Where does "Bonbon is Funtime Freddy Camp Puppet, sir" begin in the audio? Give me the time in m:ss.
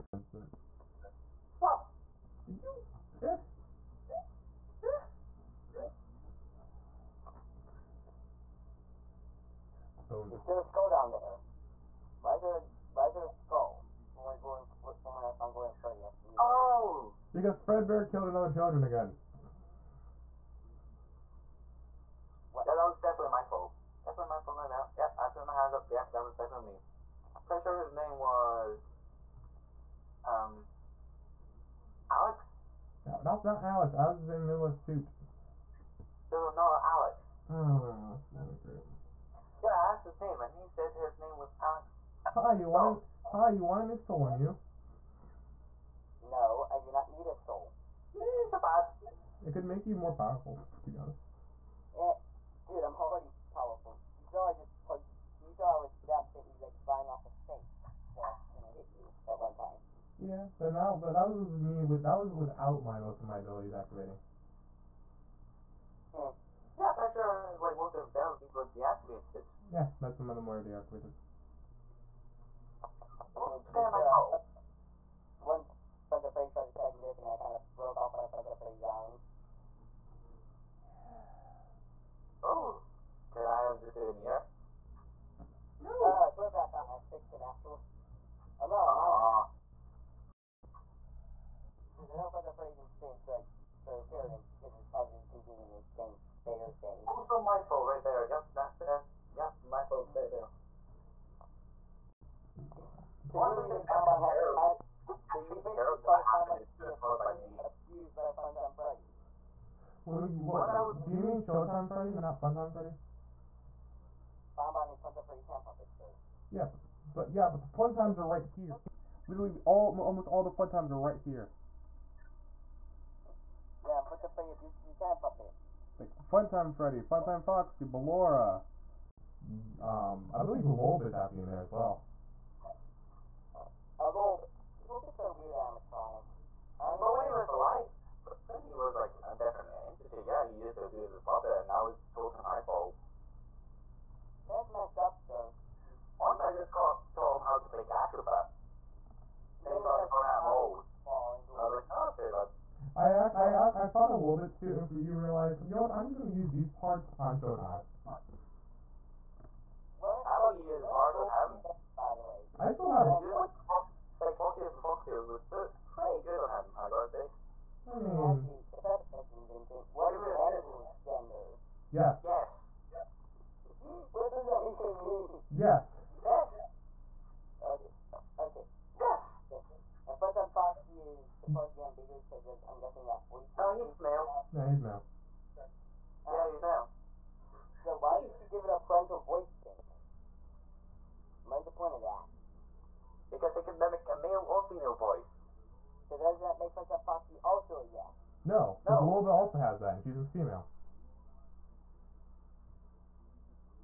1:54.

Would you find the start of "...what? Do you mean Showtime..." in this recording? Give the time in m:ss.
1:50.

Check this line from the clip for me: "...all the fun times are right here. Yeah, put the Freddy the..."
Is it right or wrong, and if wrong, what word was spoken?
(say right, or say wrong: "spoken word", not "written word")
right.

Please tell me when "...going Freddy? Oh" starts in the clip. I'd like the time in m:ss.
0:15.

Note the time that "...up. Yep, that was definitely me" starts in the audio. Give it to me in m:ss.
0:25.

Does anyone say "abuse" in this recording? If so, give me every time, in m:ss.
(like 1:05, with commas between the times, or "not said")
2:20.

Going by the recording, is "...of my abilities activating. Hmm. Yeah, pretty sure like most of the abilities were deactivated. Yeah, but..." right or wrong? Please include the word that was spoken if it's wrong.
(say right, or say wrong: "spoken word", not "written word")
right.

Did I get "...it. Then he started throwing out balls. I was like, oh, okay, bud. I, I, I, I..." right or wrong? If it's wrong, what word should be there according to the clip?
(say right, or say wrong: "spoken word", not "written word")
right.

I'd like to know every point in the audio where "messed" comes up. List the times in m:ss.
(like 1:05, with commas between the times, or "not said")
2:24.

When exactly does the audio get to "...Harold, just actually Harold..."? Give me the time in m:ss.
1:44.